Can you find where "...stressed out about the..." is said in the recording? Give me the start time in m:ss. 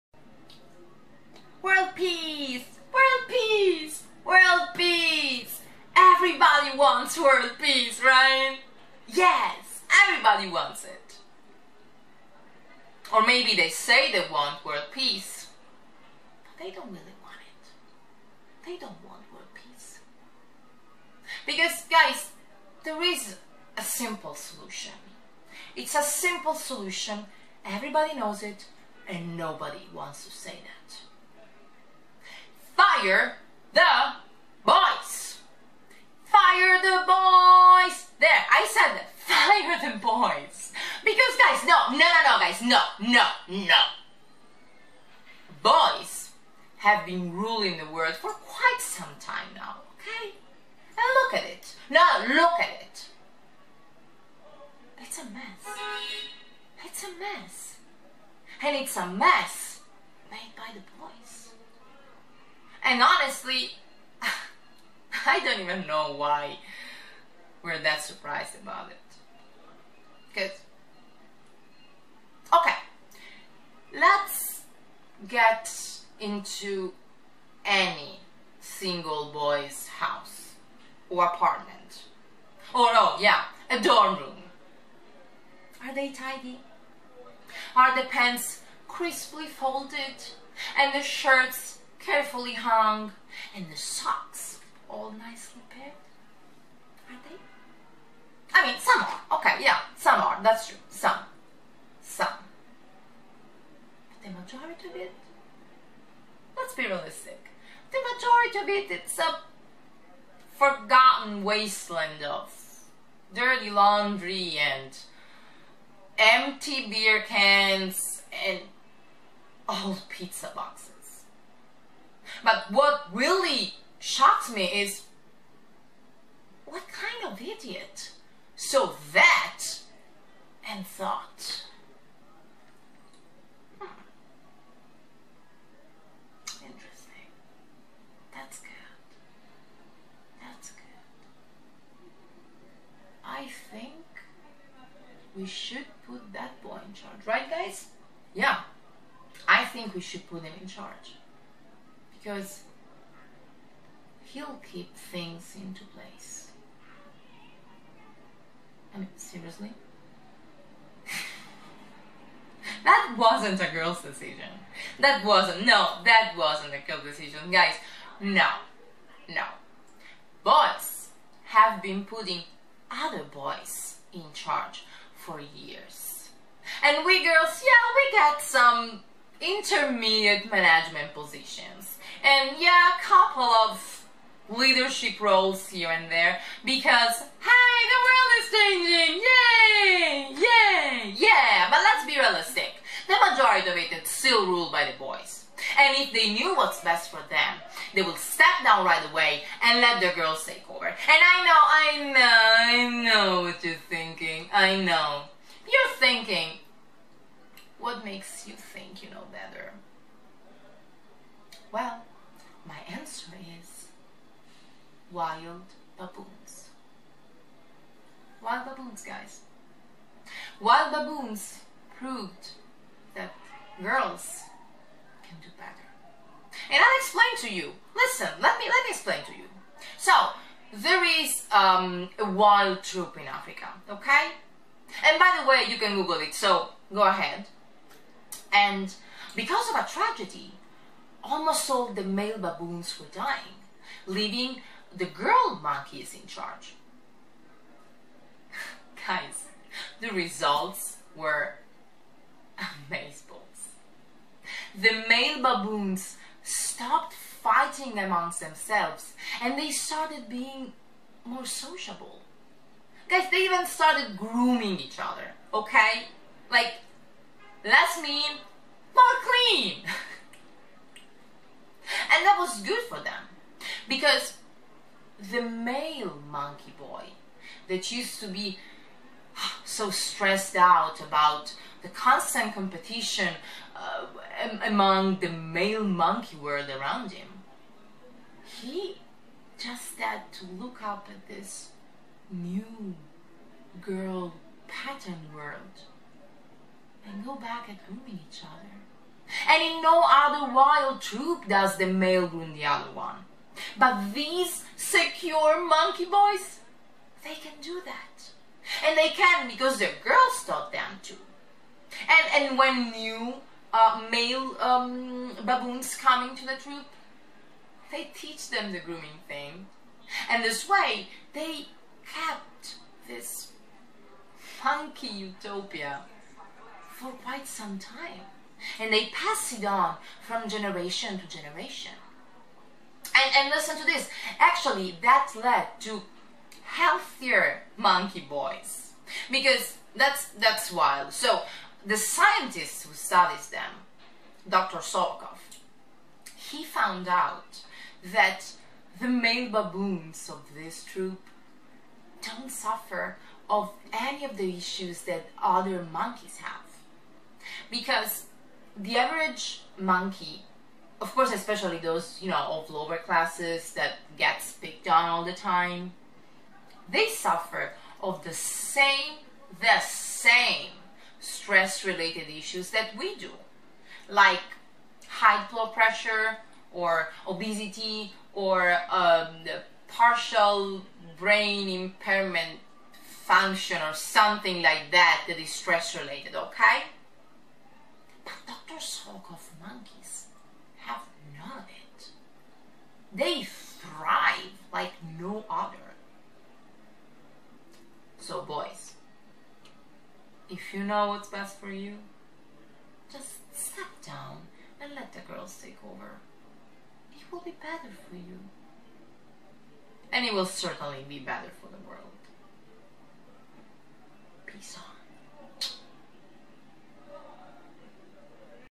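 4:39.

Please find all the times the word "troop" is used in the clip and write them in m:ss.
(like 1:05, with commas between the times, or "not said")
3:52, 5:01, 5:16, 5:50.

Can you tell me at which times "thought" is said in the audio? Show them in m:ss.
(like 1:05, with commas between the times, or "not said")
2:10.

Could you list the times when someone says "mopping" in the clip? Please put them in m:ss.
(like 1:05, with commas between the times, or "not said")
not said.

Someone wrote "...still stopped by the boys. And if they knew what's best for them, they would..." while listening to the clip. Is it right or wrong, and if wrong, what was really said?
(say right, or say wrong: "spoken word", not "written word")
wrong: "ruled", not "stopped".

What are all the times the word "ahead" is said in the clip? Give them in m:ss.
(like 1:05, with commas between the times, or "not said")
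3:57.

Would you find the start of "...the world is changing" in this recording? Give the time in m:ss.
3:07.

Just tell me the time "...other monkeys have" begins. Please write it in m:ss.
5:55.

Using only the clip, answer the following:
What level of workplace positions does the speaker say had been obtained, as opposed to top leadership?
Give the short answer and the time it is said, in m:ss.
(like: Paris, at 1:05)
Intermediate management positions, at 2:59.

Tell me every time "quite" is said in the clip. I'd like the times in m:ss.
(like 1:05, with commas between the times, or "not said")
0:48, 5:27.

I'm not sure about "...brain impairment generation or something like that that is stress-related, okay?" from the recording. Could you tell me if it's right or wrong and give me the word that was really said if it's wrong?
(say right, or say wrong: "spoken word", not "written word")
wrong: "function", not "generation".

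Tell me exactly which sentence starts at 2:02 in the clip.
But what really Shocked me is what kind of idiot?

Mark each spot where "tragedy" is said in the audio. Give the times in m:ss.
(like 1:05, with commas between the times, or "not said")
3:59.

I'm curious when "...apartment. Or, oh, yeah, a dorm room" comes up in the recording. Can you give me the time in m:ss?
1:21.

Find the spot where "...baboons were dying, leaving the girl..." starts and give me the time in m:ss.
4:02.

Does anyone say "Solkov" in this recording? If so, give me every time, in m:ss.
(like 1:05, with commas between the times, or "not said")
5:44, 6:28.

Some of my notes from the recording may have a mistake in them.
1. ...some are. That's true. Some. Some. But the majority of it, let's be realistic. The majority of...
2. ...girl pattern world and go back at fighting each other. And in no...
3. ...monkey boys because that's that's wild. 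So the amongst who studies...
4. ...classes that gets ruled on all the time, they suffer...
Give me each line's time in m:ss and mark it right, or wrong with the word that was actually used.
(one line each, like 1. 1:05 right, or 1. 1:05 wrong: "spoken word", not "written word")
1. 1:39 right
2. 4:53 wrong: "grooming", not "fighting"
3. 5:37 wrong: "scientist", not "amongst"
4. 6:02 wrong: "picked", not "ruled".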